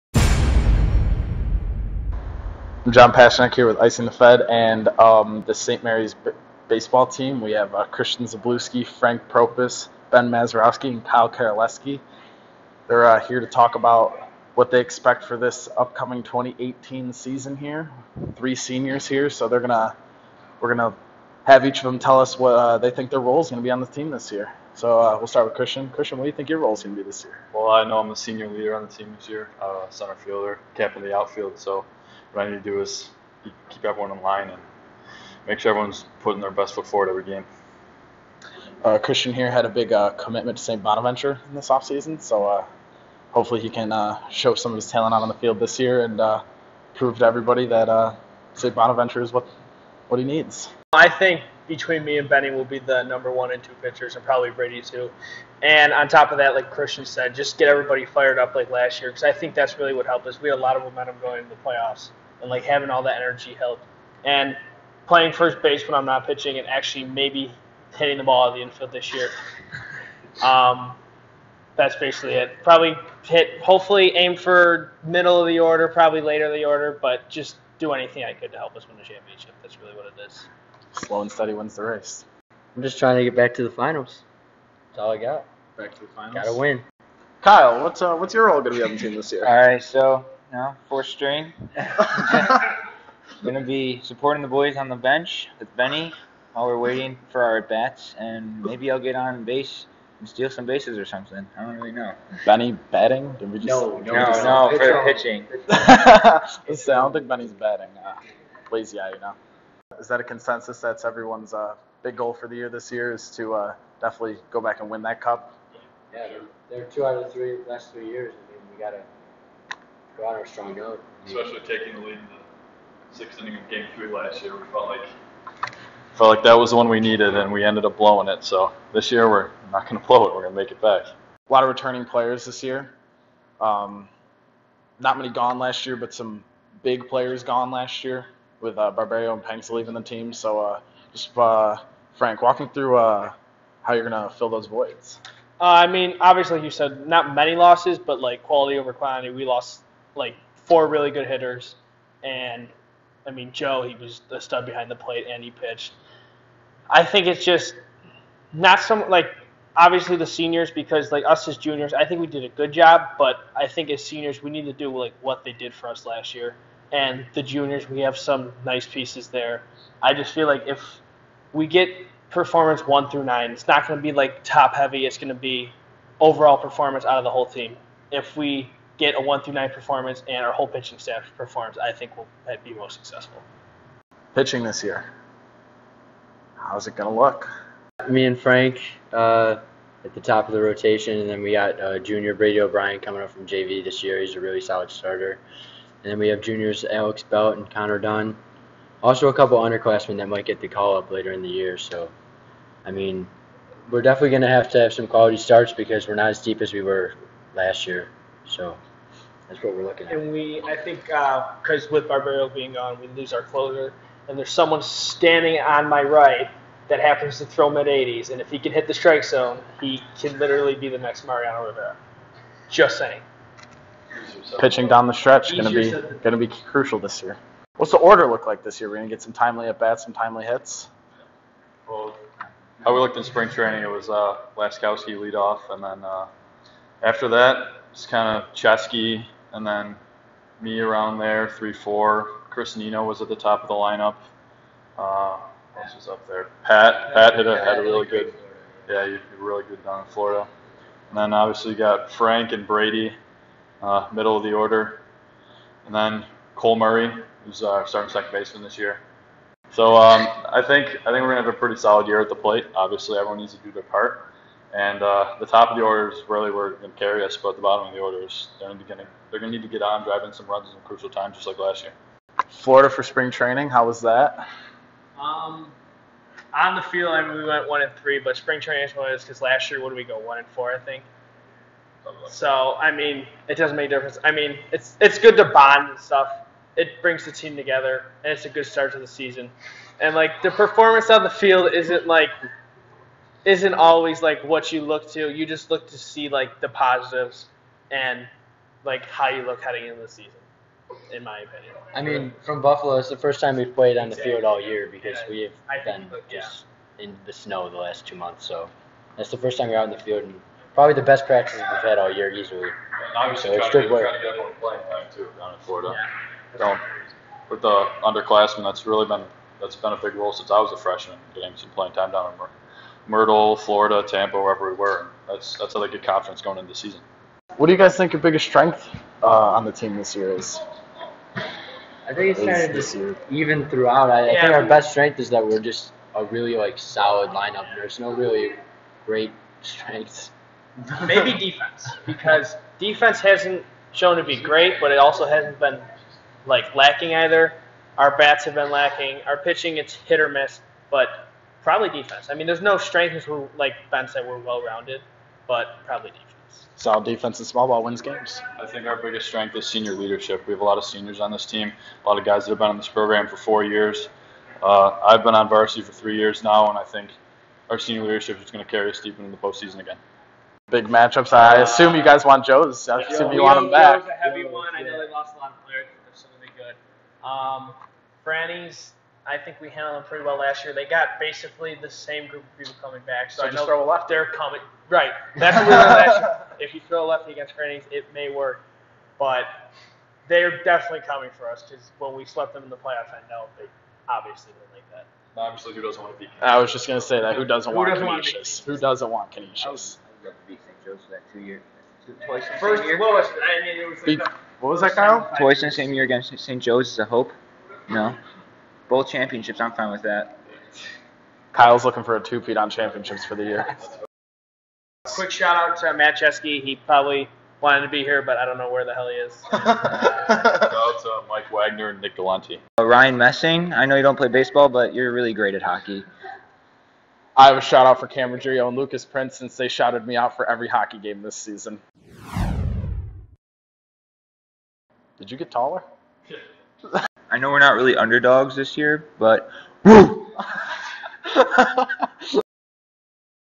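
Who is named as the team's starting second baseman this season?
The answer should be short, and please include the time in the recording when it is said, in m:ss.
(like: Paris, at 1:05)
Cole Murray, at 4:16.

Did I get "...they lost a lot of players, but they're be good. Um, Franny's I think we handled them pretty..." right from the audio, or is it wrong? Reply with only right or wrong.
right.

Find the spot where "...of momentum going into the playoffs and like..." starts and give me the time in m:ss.
1:00.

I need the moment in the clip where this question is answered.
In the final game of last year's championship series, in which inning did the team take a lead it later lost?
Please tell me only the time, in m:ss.
2:03.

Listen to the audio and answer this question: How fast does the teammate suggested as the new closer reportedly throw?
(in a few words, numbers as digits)
mid 80s.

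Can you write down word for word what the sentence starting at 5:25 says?
That's that's how they get confidence going into the season.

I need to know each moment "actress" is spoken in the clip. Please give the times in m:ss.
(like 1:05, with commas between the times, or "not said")
not said.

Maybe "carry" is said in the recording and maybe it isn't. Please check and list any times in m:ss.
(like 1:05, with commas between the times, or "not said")
4:26, 6:08.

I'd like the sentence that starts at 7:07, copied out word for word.
I have a shout out for Cameron Ruggiero and Lucas Prince since they shouted me out for every hockey game this season.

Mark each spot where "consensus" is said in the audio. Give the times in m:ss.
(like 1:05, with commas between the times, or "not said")
1:50.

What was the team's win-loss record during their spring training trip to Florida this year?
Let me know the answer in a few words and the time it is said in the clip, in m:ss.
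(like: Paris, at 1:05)
1 and 3, at 4:37.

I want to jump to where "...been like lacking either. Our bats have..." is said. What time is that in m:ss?
5:45.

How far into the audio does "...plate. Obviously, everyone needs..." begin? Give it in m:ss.
4:22.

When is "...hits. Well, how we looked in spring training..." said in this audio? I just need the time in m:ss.
3:50.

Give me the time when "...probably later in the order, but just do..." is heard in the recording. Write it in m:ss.
1:15.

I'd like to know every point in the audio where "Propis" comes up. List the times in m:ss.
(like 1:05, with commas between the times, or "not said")
0:09.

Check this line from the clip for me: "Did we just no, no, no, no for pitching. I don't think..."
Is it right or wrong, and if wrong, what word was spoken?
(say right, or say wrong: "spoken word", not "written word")
right.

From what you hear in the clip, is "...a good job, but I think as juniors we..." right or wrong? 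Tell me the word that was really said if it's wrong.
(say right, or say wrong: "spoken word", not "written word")
wrong: "seniors", not "juniors".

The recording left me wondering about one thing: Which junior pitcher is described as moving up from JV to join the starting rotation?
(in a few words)
Brady O'Brien.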